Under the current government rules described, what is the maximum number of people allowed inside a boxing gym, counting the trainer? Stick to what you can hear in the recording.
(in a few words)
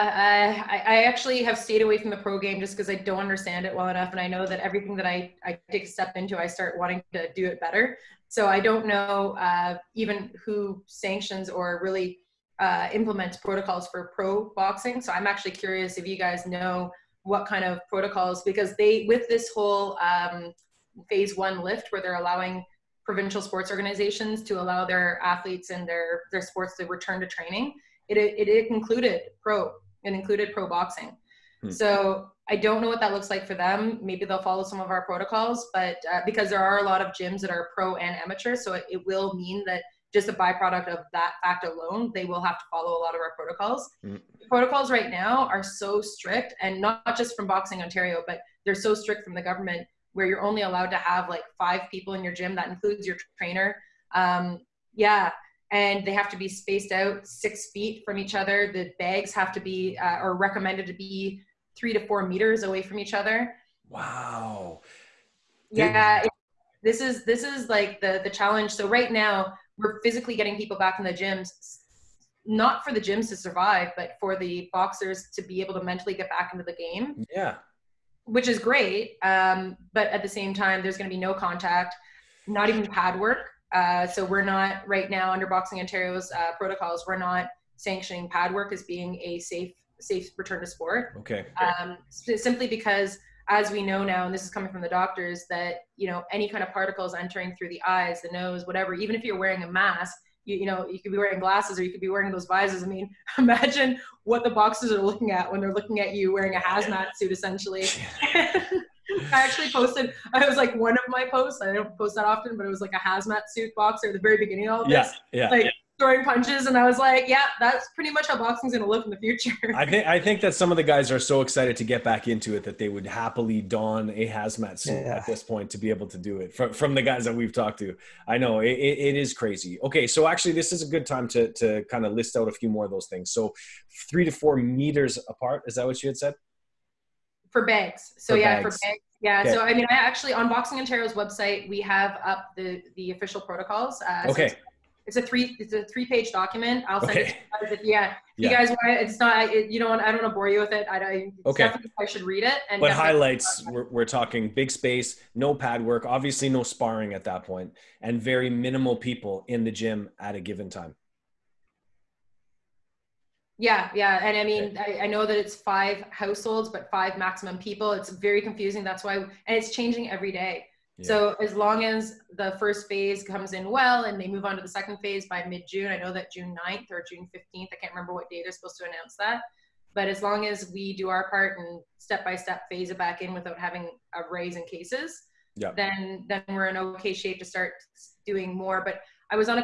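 5.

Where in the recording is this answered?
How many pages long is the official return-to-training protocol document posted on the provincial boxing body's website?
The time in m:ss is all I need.
2:25.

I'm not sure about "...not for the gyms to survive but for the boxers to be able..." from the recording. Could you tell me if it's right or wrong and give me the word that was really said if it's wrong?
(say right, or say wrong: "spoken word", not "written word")
right.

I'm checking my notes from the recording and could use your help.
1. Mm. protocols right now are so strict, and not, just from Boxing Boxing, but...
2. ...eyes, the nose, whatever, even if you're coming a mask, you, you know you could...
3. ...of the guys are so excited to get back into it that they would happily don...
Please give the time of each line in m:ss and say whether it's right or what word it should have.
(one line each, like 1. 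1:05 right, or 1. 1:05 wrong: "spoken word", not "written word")
1. 0:44 wrong: "Ontario", not "Boxing"
2. 1:37 wrong: "wearing", not "coming"
3. 2:00 right.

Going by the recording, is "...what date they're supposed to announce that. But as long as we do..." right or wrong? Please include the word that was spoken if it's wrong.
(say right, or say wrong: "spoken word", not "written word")
right.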